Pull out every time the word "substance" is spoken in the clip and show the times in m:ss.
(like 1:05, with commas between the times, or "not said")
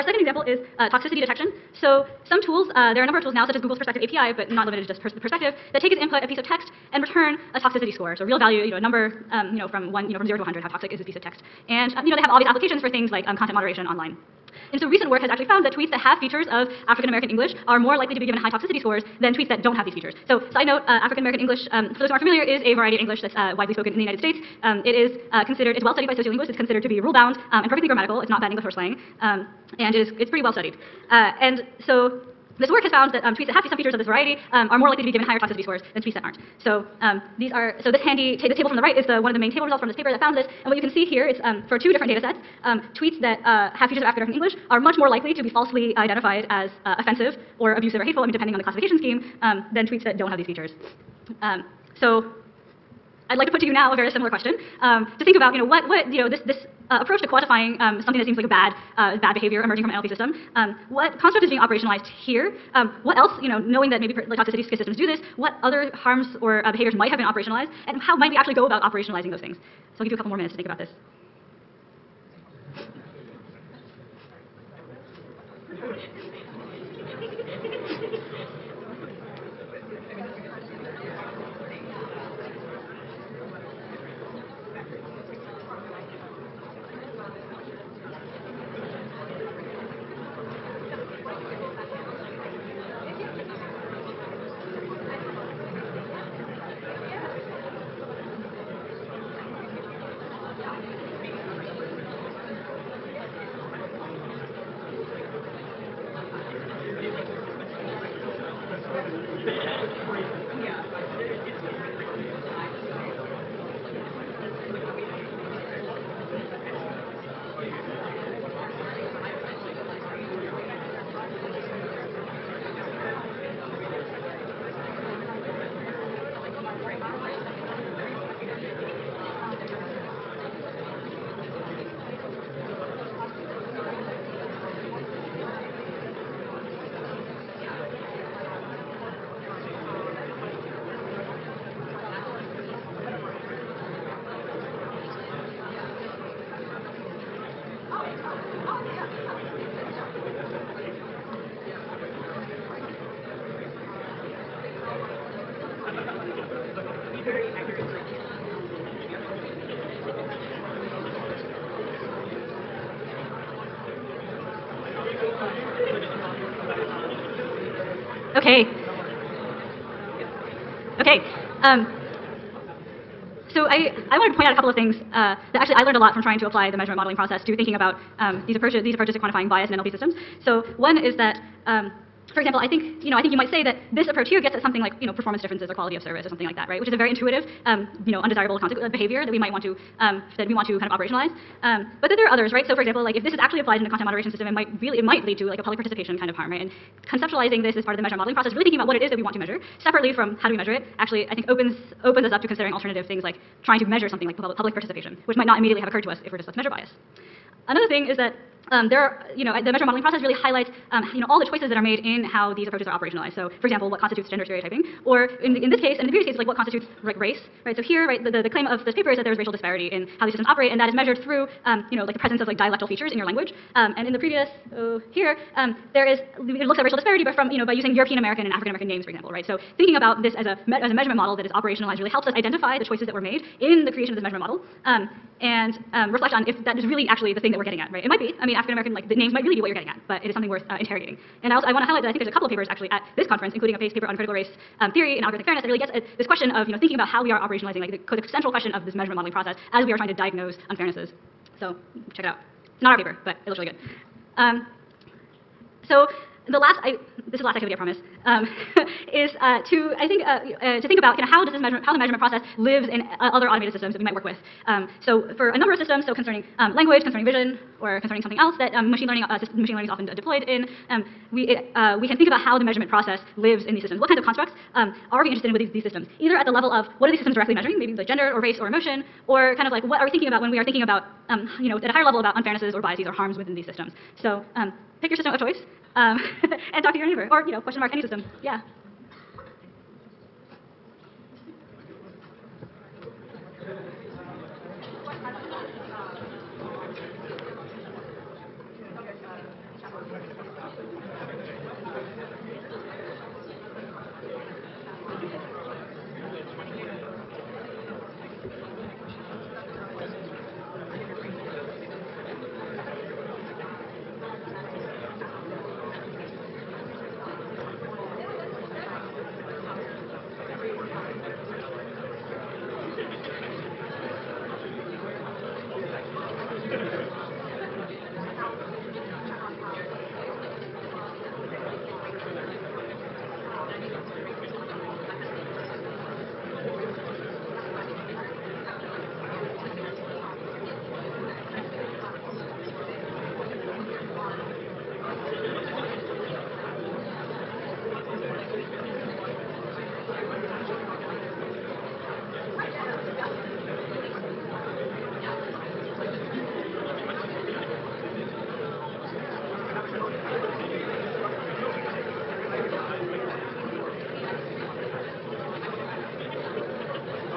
not said.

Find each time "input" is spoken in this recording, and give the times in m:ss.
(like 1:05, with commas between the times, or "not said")
0:05.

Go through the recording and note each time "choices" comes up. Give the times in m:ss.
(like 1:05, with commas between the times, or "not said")
3:31, 3:52, 4:45.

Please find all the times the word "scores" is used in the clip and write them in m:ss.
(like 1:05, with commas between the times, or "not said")
0:07, 0:18, 0:35.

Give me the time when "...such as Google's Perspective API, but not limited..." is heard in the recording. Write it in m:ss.
0:03.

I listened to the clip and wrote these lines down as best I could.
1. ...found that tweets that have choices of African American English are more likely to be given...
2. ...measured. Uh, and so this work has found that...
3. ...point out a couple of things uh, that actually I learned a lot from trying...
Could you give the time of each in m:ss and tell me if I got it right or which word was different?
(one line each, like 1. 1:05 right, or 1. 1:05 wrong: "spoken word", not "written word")
1. 0:15 wrong: "features", not "choices"
2. 0:30 wrong: "studied", not "measured"
3. 2:54 right.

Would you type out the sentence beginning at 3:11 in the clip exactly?
Um, but that there are others, right?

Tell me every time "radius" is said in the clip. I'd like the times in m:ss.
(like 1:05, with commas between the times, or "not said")
not said.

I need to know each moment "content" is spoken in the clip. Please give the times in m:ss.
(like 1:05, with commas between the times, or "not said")
0:13, 3:13.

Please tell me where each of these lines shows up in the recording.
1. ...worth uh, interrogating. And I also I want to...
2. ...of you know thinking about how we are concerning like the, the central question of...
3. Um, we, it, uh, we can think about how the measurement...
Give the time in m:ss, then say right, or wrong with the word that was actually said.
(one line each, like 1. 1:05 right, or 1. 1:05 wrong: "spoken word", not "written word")
1. 4:00 right
2. 4:06 wrong: "operationalizing", not "concerning"
3. 4:30 right.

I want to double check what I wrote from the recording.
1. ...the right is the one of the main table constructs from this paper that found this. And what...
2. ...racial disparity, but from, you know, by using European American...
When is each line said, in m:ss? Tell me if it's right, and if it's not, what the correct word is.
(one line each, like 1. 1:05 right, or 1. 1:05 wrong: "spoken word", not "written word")
1. 0:38 wrong: "results", not "constructs"
2. 3:46 right.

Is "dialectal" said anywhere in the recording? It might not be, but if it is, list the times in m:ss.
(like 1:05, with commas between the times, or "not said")
3:42.